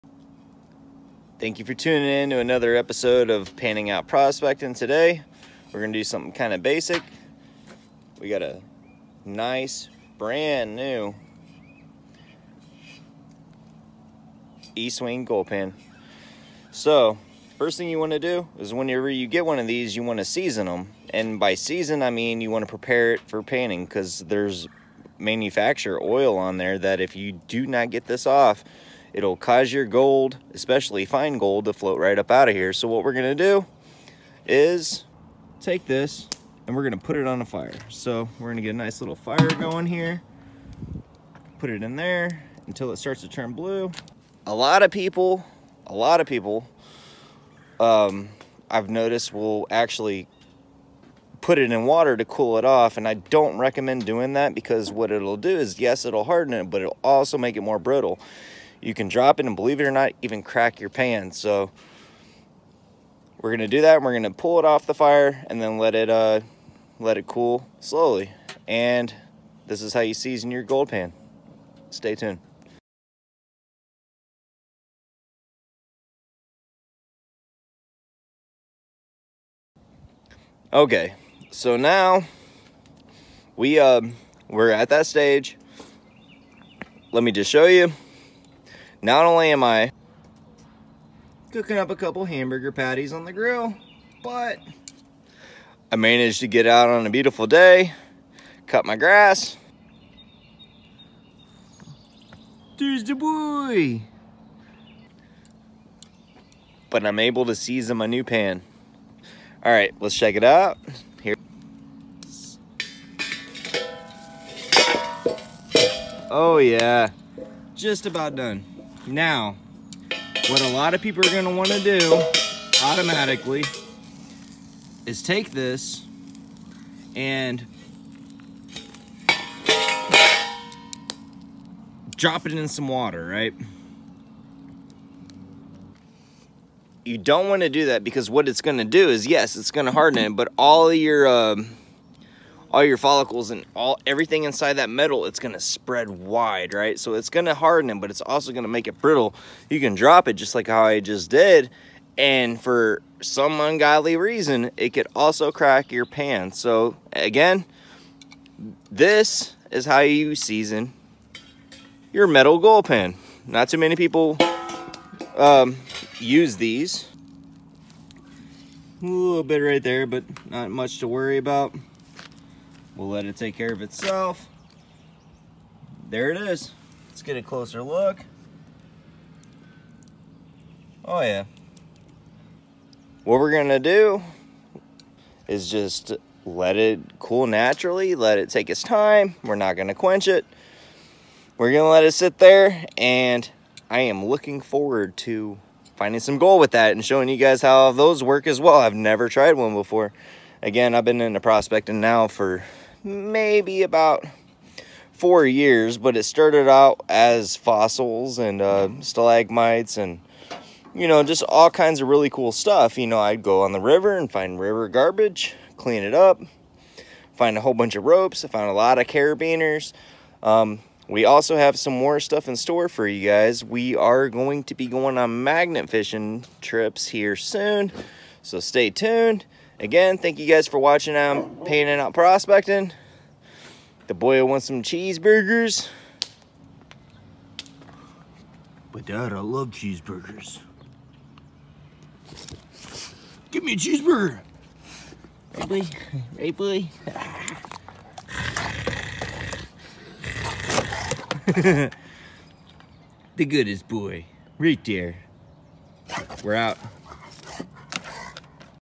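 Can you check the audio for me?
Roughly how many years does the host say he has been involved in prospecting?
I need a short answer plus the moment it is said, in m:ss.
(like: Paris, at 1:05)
4, at 3:25.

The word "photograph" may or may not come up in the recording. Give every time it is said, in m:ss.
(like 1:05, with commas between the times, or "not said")
not said.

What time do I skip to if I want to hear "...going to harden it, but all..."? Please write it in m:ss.
2:19.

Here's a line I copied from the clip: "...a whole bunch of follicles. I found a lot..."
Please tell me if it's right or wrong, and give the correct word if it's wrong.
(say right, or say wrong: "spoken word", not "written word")
wrong: "ropes", not "follicles".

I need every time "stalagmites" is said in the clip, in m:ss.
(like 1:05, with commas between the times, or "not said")
3:29.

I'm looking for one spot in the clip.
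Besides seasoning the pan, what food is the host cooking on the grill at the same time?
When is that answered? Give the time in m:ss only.
1:32.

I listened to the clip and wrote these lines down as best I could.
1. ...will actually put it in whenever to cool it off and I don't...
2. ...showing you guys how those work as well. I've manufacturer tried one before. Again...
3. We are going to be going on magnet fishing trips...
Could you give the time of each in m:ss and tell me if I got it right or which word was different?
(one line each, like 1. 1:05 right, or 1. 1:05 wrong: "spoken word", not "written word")
1. 0:49 wrong: "water", not "whenever"
2. 3:17 wrong: "never", not "manufacturer"
3. 3:43 right.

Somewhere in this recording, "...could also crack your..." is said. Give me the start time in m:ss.
2:34.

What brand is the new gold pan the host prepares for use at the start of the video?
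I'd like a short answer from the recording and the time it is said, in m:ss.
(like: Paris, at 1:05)
Estwing, at 0:14.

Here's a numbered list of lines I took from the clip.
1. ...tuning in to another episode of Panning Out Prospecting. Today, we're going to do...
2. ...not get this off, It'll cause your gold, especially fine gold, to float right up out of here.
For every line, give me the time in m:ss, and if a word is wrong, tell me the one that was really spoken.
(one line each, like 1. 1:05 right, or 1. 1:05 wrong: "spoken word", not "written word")
1. 0:01 right
2. 0:27 right.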